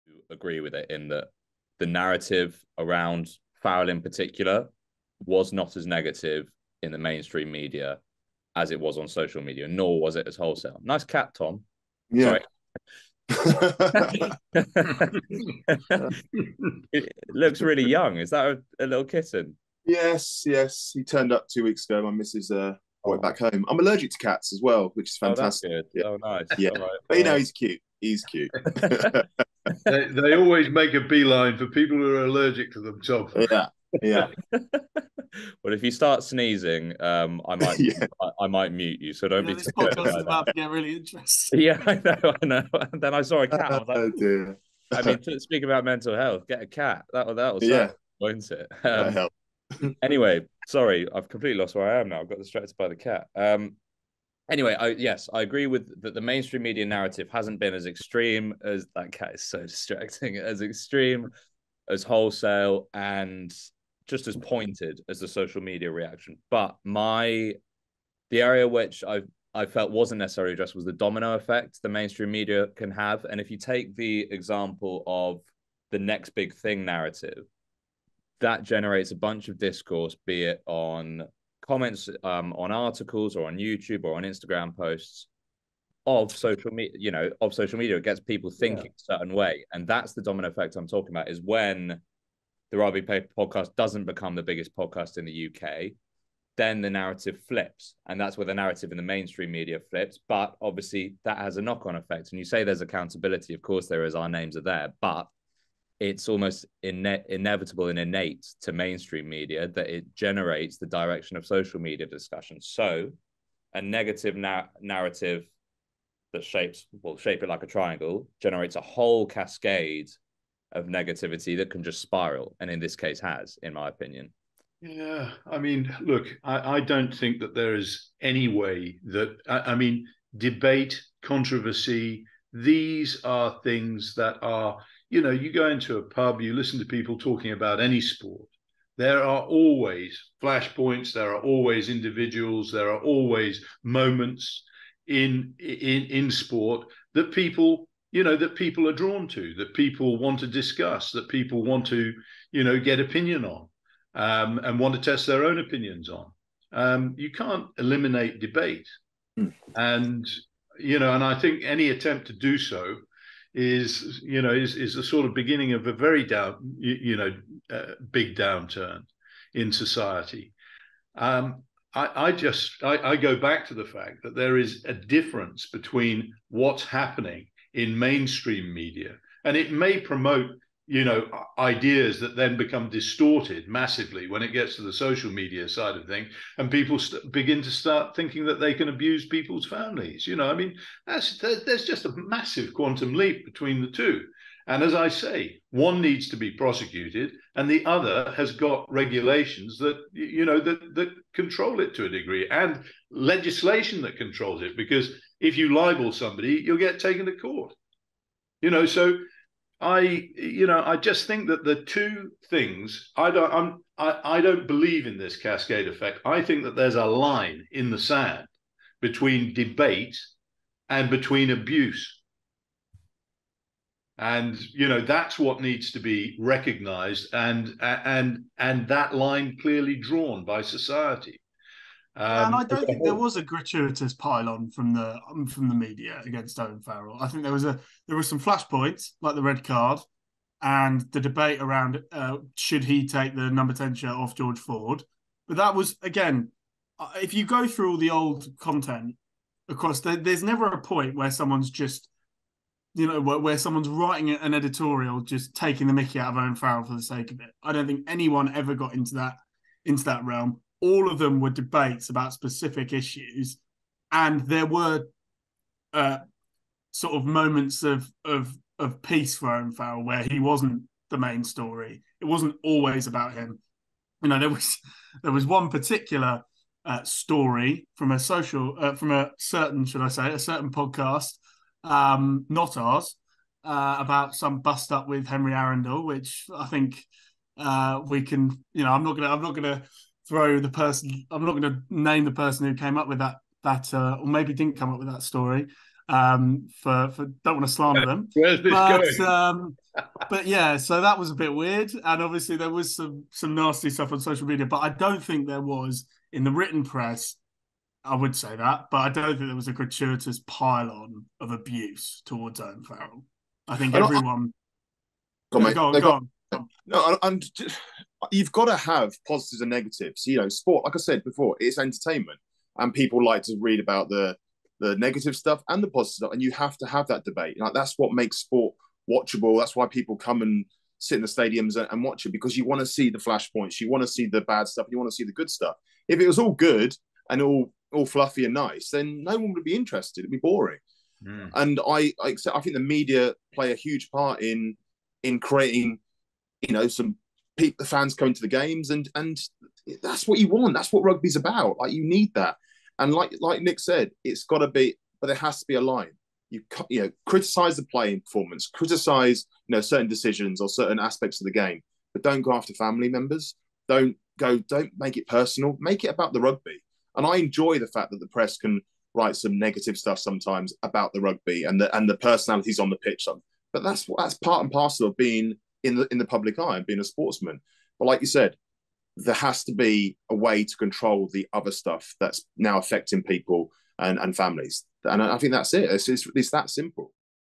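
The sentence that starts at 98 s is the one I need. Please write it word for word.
And that's where the narrative in the mainstream media flips.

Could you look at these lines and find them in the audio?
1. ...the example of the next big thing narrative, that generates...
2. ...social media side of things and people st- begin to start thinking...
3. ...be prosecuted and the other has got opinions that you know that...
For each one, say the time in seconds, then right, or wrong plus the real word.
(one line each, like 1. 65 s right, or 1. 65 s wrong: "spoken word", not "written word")
1. 73 s right
2. 184 s right
3. 196 s wrong: "regulations", not "opinions".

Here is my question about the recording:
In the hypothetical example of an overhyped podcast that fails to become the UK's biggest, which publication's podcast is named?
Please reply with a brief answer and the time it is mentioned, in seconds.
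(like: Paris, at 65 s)
Rugby Paper, at 92 s.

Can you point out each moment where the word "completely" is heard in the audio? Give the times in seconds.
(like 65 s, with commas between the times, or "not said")
51 s.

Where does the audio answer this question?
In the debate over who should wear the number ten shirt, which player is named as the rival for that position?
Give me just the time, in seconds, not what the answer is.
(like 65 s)
244 s.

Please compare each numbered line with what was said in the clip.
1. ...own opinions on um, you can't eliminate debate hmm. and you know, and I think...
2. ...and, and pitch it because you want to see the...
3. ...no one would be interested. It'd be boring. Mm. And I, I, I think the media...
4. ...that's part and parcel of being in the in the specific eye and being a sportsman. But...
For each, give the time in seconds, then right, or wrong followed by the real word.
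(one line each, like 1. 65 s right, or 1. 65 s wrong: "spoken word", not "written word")
1. 155 s right
2. 331 s wrong: "watch", not "pitch"
3. 339 s right
4. 374 s wrong: "public", not "specific".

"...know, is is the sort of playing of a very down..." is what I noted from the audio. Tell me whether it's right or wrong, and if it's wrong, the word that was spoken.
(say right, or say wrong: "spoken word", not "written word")
wrong: "beginning", not "playing".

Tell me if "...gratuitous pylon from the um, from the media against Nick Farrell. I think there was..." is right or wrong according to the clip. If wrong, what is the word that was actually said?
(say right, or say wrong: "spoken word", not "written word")
wrong: "Owen", not "Nick".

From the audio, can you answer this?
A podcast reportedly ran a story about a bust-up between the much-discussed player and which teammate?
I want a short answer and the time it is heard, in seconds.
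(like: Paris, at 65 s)
Henry Arundell, at 285 s.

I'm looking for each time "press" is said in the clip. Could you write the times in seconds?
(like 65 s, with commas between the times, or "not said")
306 s, 368 s.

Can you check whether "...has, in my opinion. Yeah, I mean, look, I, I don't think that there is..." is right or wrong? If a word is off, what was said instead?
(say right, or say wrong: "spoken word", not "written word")
right.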